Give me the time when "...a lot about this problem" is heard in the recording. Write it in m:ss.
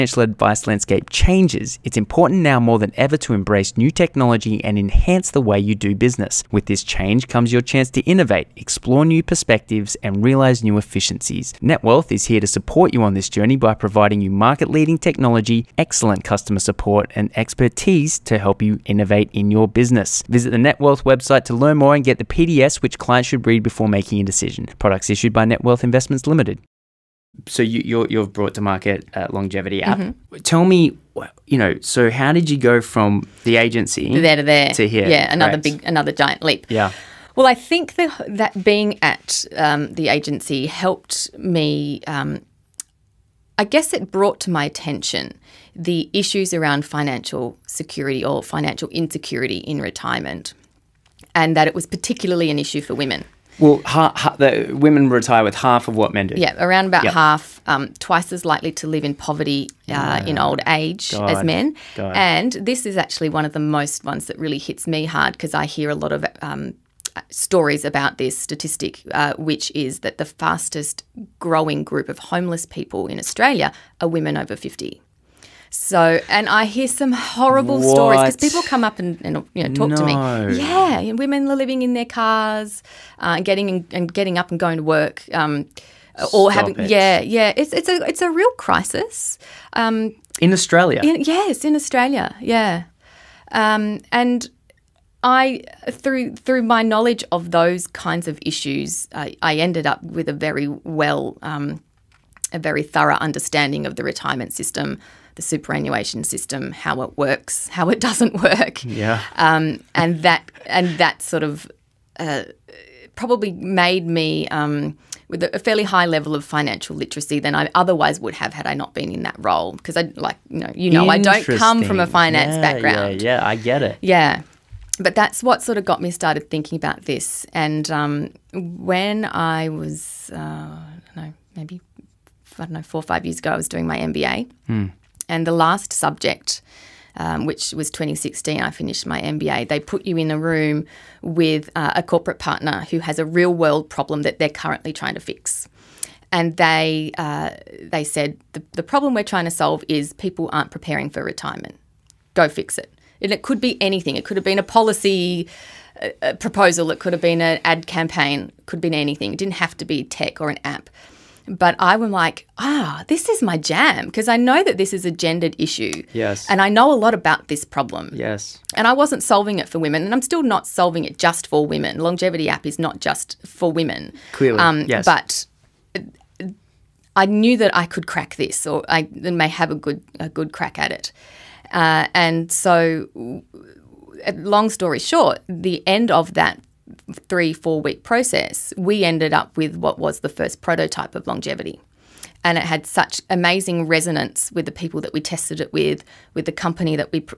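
2:46.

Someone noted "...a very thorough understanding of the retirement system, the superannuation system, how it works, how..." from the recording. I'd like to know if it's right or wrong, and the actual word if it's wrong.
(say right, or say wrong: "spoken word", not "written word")
right.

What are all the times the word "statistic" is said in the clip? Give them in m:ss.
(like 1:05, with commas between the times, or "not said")
1:08.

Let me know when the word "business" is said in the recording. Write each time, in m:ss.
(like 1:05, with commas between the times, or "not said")
0:05, 0:19.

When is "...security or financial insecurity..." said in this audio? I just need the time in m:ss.
0:47.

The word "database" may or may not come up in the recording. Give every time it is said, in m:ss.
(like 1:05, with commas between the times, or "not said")
not said.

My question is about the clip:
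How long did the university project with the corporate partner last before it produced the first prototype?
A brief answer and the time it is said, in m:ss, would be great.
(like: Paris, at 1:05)
3 to 4 weeks, at 3:07.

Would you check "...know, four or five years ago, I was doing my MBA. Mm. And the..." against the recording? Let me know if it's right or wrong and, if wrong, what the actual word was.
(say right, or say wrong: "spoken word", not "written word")
right.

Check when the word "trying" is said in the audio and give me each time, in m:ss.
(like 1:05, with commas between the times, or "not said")
2:24, 2:29.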